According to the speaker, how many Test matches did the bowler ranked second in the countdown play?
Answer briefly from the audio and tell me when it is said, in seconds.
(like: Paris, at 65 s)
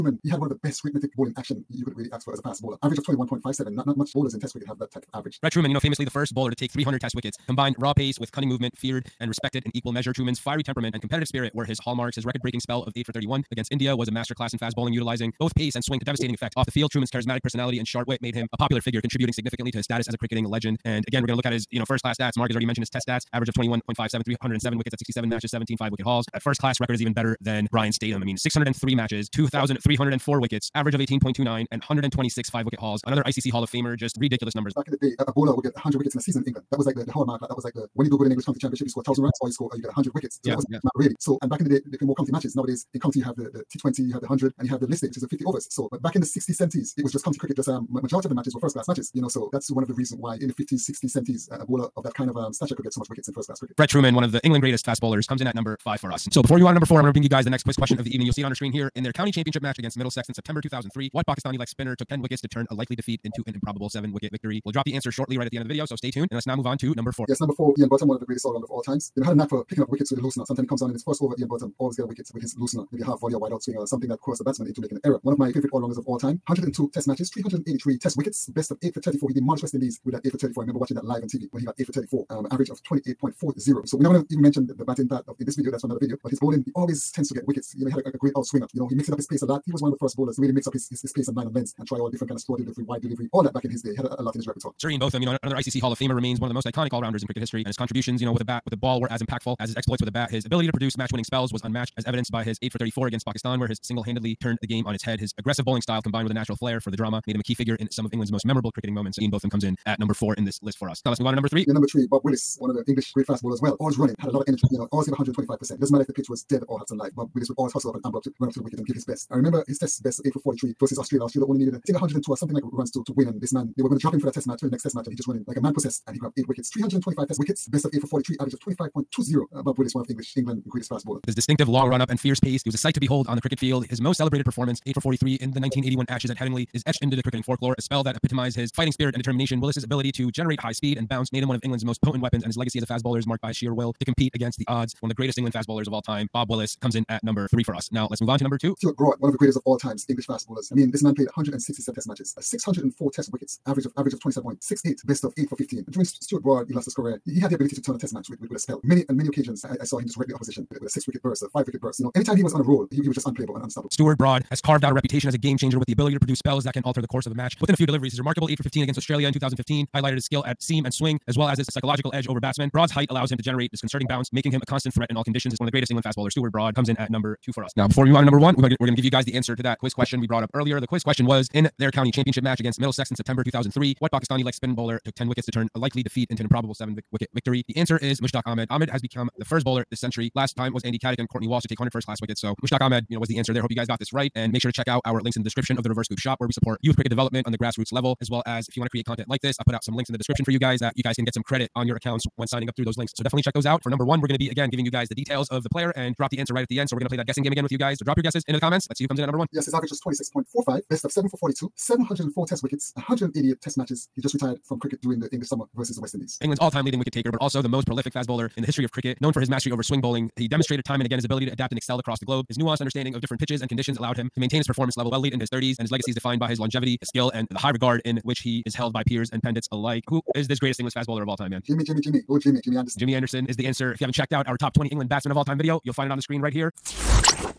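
167, at 151 s.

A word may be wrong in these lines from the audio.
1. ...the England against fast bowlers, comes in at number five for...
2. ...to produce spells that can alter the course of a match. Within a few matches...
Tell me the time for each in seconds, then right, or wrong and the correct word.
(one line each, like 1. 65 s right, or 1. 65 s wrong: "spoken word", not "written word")
1. 54 s wrong: "greatest", not "against"
2. 166 s wrong: "deliveries", not "matches".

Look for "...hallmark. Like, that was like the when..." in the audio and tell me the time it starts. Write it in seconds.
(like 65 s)
37 s.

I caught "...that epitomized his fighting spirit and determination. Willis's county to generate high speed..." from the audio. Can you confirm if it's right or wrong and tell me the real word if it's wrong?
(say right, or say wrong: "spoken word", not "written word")
wrong: "ability", not "county".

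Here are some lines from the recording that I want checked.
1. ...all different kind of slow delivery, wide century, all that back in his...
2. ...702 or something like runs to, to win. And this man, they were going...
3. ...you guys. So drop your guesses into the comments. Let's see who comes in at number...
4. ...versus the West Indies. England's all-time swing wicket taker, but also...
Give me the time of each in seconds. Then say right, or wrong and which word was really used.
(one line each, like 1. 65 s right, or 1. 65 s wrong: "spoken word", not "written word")
1. 91 s wrong: "delivery", not "century"
2. 121 s wrong: "102", not "702"
3. 207 s right
4. 215 s wrong: "leading", not "swing".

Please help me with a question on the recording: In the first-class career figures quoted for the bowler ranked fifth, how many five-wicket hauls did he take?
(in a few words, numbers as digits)
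126.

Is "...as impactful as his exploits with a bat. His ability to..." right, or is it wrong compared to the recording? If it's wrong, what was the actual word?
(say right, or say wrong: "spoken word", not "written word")
right.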